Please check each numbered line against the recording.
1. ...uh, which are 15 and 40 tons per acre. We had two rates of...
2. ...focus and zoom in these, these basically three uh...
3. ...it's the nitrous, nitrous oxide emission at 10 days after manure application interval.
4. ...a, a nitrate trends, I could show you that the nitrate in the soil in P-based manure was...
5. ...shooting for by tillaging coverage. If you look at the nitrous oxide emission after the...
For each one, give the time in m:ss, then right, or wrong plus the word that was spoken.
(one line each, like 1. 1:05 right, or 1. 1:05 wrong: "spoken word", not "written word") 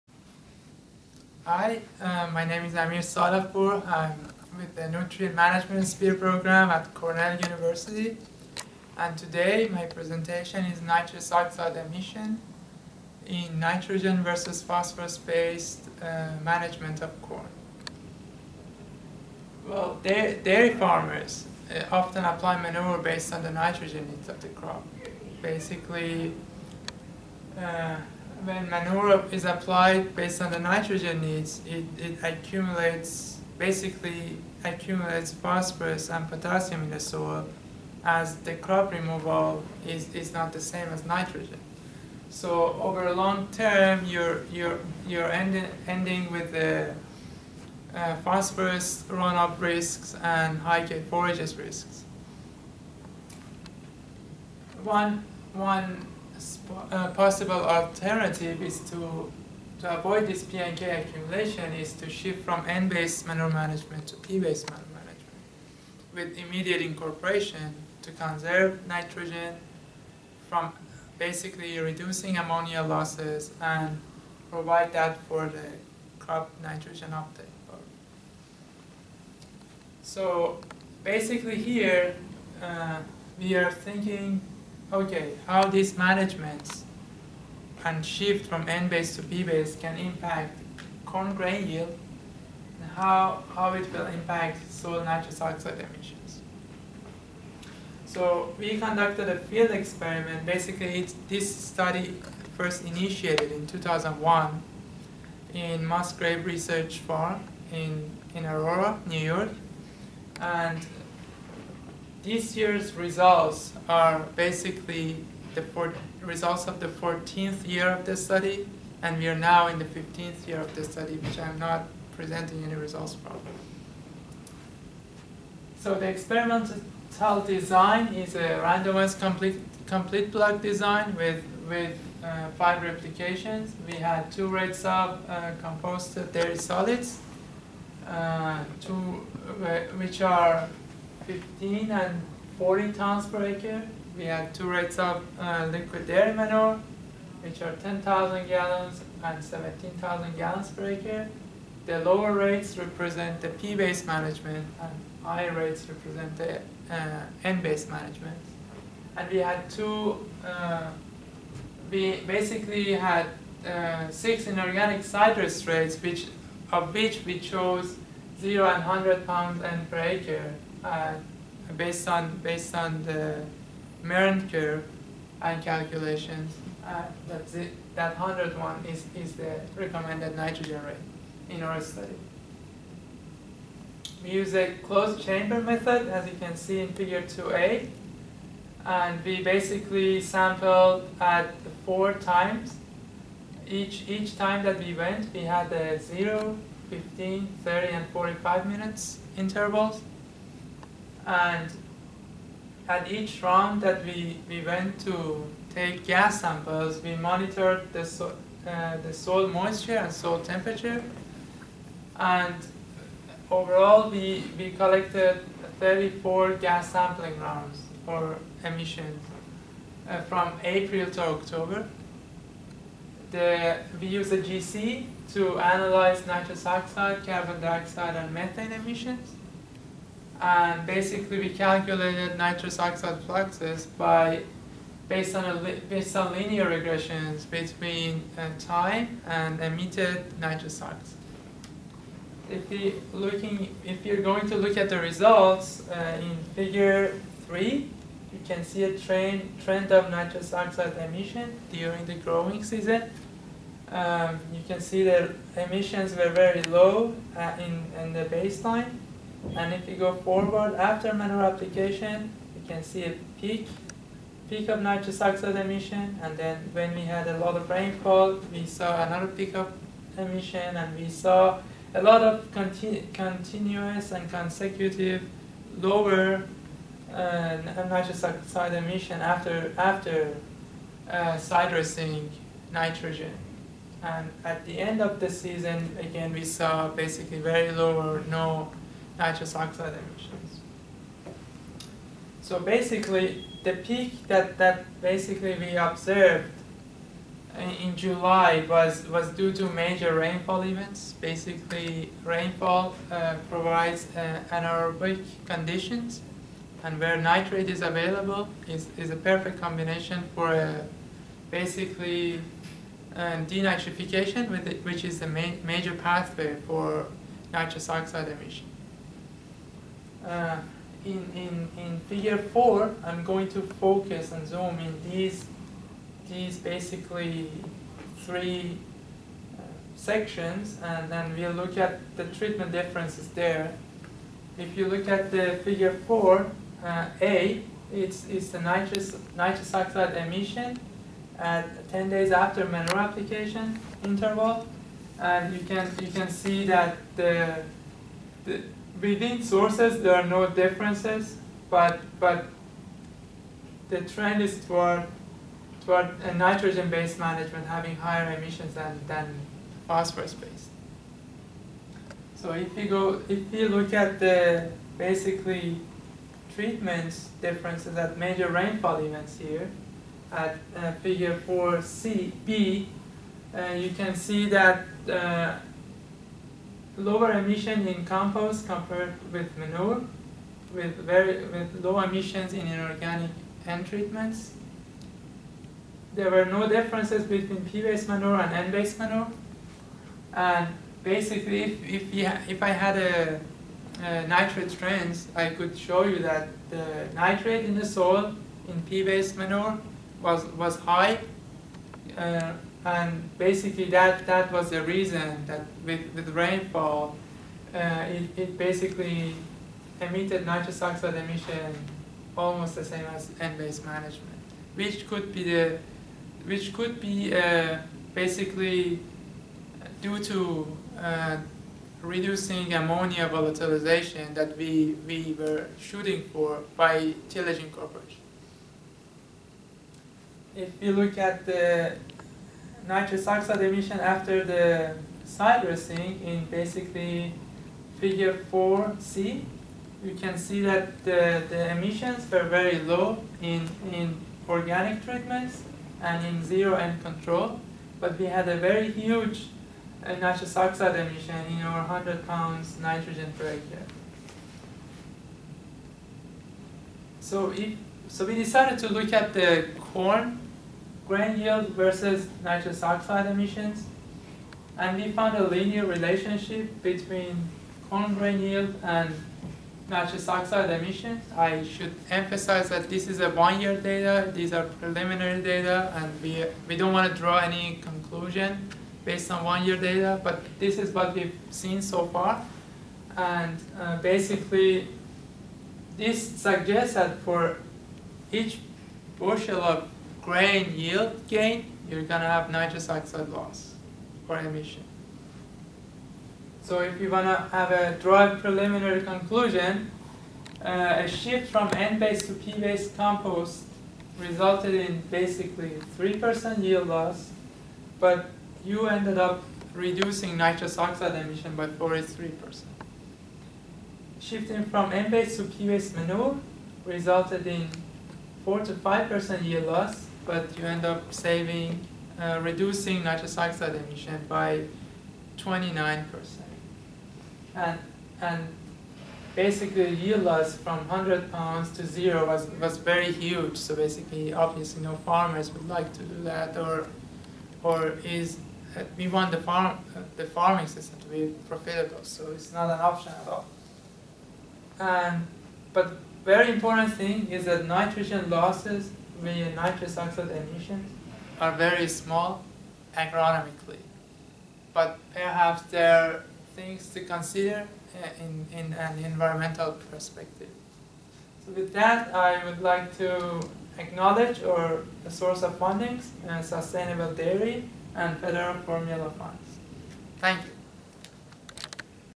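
1. 2:19 right
2. 5:23 right
3. 5:38 right
4. 6:32 right
5. 7:05 right.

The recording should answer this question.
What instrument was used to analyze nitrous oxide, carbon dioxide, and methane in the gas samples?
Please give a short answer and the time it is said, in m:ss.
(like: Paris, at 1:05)
GC, at 3:44.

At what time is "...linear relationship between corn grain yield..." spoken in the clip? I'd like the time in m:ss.
7:45.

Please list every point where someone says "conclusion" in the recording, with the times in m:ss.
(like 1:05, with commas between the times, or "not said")
7:57, 8:19.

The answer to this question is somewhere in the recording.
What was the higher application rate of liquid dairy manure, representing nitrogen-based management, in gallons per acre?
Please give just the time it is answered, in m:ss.
2:29.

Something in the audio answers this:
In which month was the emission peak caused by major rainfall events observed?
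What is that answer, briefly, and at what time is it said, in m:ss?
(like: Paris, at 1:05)
July, at 4:57.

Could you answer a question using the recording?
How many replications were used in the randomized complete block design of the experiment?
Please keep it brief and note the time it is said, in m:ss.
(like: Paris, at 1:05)
5, at 2:12.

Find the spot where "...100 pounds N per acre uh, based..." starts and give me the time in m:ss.
2:48.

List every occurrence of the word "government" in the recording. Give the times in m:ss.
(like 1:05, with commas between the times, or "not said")
not said.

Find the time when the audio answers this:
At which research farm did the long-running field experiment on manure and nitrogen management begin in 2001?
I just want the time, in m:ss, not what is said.
1:45.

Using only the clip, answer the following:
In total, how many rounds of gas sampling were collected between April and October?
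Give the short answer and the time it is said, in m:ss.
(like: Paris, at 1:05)
34, at 3:35.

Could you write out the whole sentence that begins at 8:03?
And uh, basically, this suggests that for each bushel of grain yield gain, you're going to have nitrous oxide loss or emission.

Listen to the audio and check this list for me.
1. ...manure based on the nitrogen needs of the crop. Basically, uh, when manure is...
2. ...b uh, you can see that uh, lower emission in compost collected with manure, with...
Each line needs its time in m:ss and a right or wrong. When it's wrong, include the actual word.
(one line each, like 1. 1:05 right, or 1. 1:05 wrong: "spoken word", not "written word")
1. 0:22 right
2. 6:12 wrong: "compared", not "collected".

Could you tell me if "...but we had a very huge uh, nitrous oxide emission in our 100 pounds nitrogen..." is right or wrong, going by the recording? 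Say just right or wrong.
right.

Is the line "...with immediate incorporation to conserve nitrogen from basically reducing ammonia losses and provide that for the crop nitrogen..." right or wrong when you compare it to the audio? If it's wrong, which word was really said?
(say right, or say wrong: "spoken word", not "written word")
right.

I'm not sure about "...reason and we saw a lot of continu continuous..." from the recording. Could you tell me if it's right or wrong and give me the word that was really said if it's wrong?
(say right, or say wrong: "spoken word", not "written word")
wrong: "emission", not "reason".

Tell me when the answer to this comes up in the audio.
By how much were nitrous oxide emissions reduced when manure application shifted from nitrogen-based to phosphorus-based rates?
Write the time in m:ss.
8:45.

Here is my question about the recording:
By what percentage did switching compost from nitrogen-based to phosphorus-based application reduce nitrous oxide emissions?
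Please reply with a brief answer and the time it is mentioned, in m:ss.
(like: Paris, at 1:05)
43%, at 8:31.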